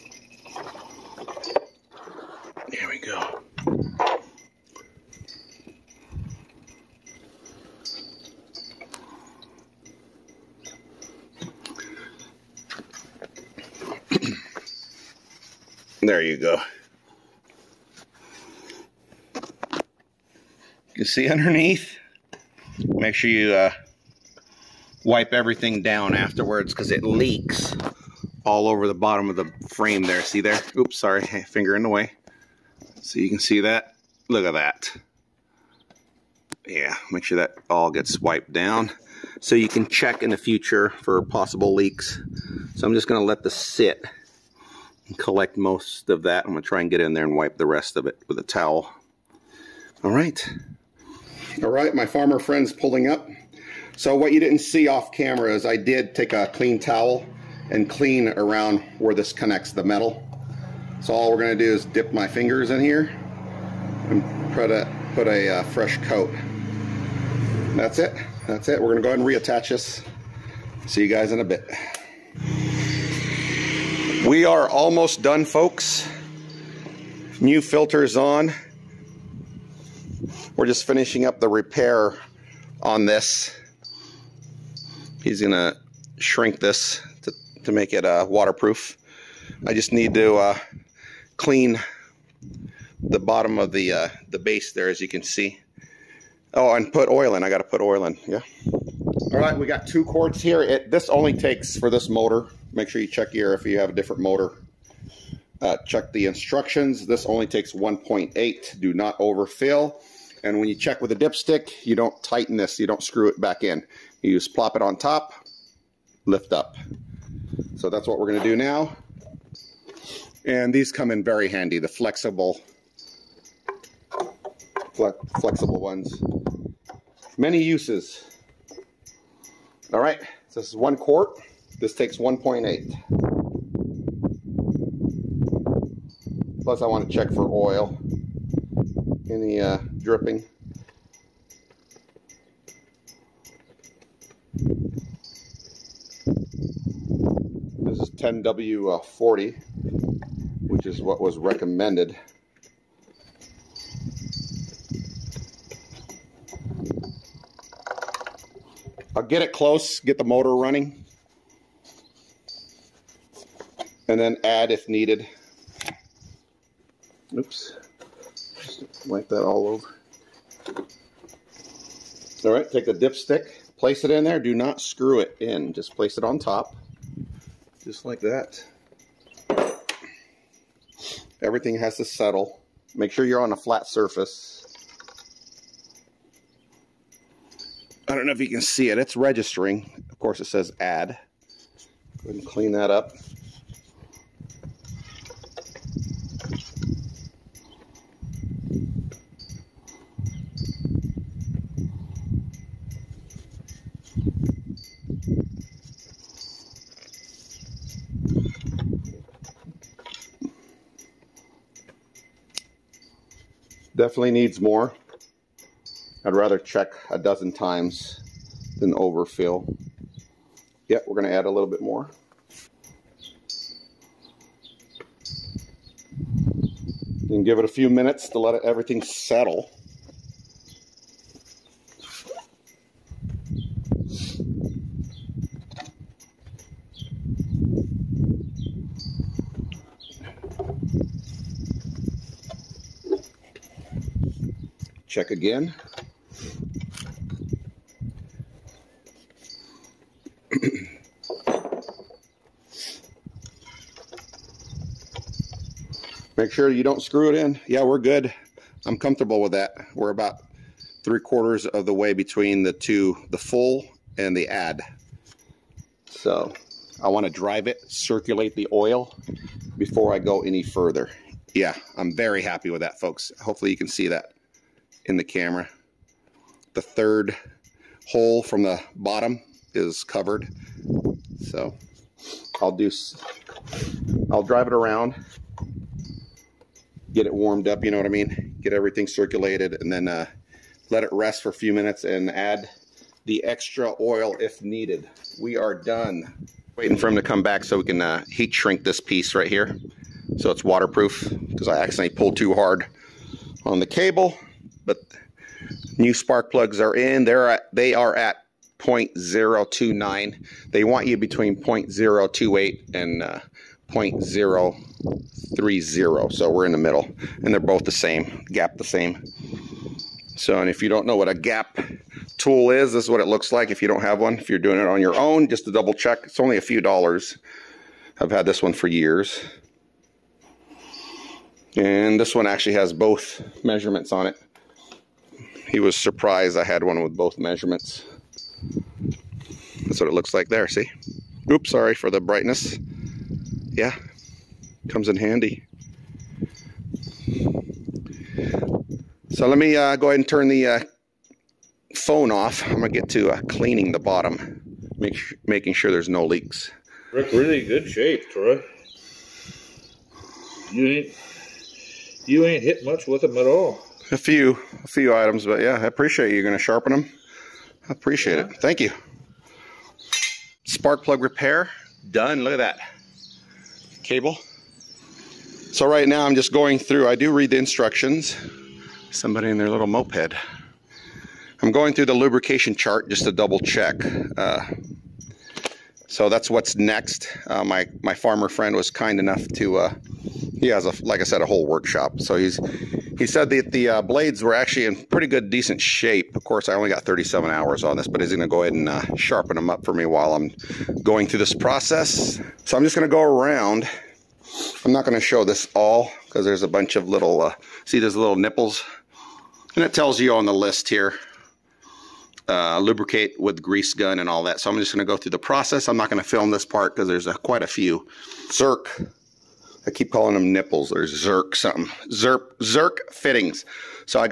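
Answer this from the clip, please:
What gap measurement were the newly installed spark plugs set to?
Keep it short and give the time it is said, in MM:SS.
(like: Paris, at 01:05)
0.029, at 05:08.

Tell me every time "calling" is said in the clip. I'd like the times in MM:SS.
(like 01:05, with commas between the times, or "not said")
07:00.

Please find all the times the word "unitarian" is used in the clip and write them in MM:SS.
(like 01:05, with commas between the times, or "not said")
not said.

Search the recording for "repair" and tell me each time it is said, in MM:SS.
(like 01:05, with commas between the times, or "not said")
01:21, 06:11.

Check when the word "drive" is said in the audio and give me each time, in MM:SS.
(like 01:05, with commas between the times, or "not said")
04:27, 04:44.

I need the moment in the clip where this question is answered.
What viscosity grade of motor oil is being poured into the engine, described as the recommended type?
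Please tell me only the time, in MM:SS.
02:28.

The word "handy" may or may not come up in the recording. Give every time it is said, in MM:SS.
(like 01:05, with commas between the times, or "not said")
02:01, 05:45.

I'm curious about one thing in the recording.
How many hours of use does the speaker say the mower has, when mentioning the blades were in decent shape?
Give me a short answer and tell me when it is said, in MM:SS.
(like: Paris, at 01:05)
37, at 06:37.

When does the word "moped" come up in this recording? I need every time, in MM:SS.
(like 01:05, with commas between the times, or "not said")
06:19.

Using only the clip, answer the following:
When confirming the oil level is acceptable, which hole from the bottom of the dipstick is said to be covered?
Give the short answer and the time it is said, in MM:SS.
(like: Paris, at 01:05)
third, at 04:36.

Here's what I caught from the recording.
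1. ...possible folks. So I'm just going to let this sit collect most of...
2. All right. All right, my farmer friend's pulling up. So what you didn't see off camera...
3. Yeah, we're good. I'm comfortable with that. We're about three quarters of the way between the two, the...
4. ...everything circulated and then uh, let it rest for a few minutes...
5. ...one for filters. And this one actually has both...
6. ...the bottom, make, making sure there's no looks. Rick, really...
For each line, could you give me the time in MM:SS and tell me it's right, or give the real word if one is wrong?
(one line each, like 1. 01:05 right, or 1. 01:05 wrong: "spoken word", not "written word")
1. 00:41 wrong: "leaks", not "folks"
2. 00:50 right
3. 04:17 right
4. 04:48 right
5. 05:28 wrong: "years", not "filters"
6. 05:53 wrong: "leaks", not "looks".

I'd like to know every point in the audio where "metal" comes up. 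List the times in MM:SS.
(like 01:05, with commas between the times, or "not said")
00:59.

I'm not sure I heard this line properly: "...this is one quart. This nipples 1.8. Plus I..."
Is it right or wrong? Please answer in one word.
wrong.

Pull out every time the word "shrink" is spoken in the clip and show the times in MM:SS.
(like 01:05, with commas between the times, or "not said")
01:26, 04:58.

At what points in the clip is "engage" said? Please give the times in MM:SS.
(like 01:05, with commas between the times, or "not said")
not said.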